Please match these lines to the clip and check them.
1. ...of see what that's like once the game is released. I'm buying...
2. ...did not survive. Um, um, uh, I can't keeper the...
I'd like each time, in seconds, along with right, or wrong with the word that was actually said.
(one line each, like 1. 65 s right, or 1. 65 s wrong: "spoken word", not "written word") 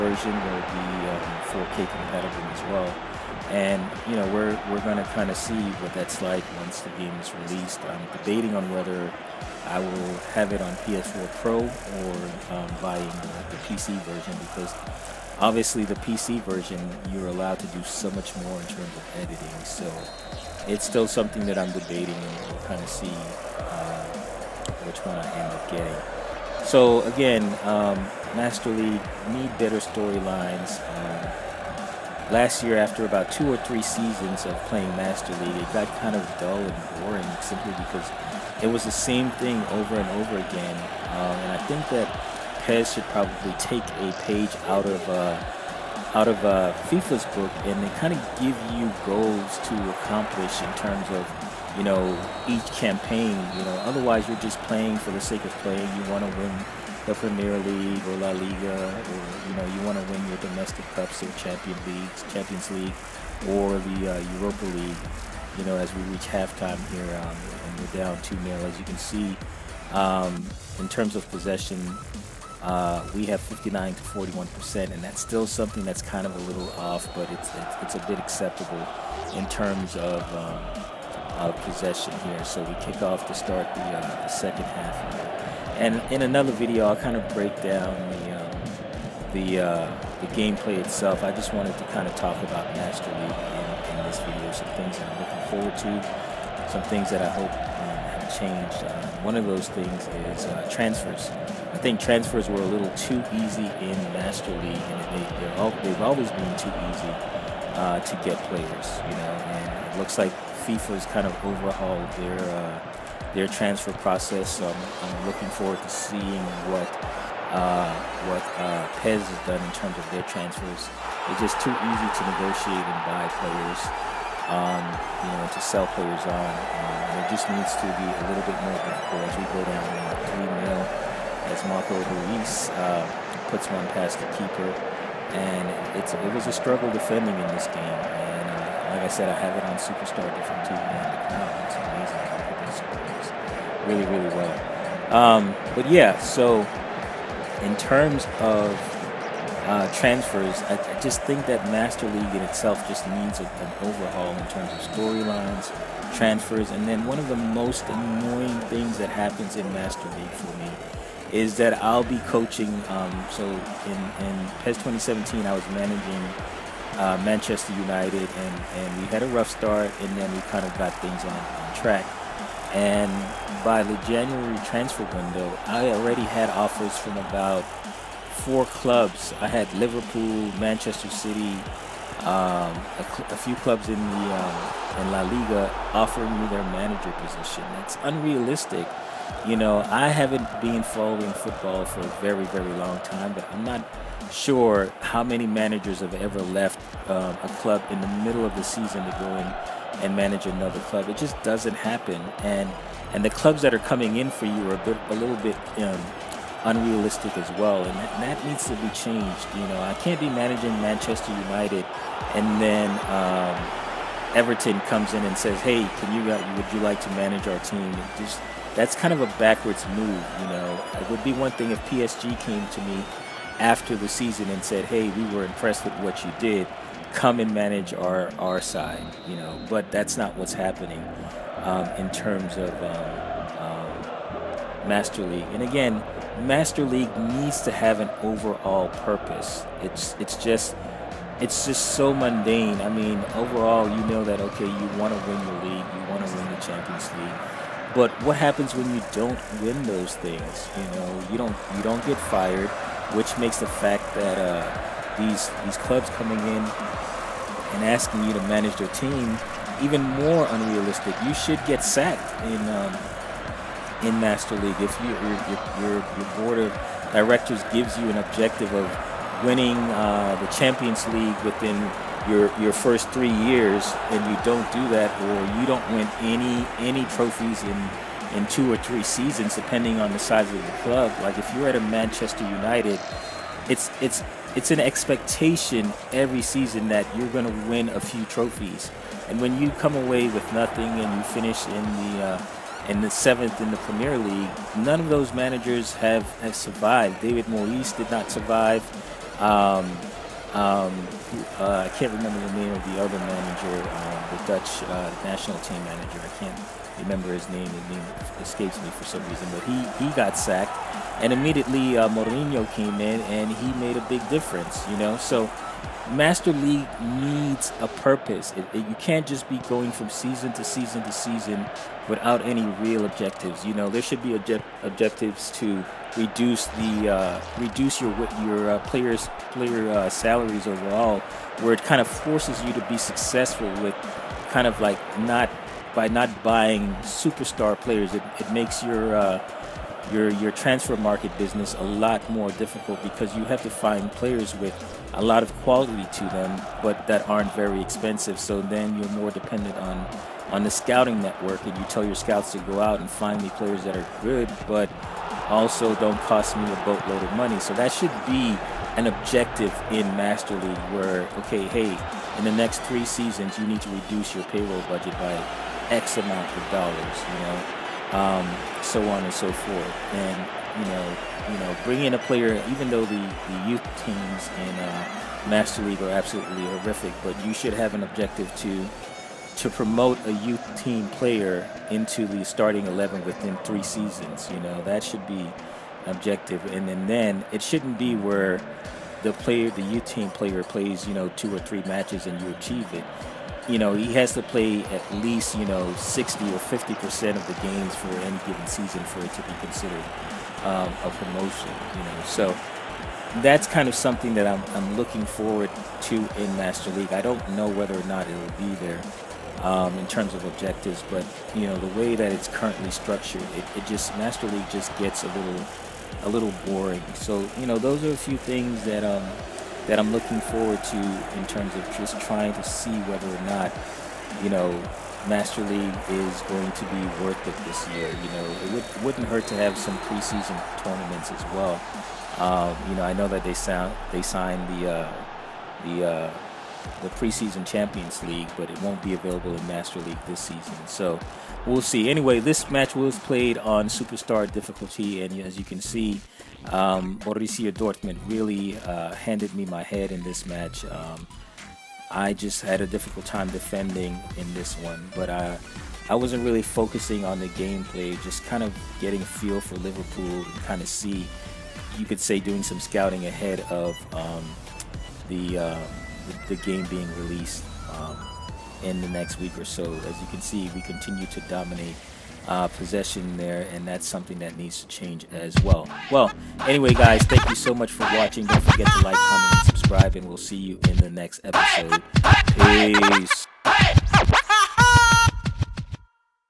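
1. 5 s wrong: "debating", not "buying"
2. 297 s wrong: "remember", not "keeper".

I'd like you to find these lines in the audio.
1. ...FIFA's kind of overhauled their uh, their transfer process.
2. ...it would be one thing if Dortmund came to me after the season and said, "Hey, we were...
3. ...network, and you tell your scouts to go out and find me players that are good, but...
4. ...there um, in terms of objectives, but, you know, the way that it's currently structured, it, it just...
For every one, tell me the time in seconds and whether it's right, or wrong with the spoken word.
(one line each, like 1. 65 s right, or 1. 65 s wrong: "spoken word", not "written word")
1. 110 s right
2. 220 s wrong: "PSG", not "Dortmund"
3. 351 s right
4. 408 s right.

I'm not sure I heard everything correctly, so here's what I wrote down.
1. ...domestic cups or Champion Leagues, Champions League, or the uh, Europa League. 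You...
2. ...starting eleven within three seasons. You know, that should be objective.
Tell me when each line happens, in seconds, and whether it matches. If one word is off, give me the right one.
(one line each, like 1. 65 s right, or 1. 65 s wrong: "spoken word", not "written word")
1. 60 s right
2. 382 s right.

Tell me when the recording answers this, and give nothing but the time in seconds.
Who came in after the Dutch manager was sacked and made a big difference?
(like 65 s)
312 s.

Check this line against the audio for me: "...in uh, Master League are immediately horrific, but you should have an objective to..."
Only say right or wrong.
wrong.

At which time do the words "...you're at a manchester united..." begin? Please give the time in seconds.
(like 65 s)
281 s.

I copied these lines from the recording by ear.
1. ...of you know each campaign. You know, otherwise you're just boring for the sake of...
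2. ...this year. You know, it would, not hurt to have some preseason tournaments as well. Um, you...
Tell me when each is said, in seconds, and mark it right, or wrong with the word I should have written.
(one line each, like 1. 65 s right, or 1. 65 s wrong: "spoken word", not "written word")
1. 51 s wrong: "playing", not "boring"
2. 427 s right.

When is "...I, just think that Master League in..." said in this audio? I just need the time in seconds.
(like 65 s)
150 s.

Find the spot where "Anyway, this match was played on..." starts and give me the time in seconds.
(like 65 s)
442 s.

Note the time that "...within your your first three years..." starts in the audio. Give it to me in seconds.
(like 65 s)
271 s.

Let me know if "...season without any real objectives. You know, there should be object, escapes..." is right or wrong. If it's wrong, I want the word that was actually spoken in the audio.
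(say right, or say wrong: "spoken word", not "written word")
wrong: "objectives", not "escapes".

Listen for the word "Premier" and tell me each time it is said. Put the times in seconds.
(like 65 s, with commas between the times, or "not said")
57 s, 293 s.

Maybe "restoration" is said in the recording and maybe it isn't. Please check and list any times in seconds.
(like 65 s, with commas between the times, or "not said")
not said.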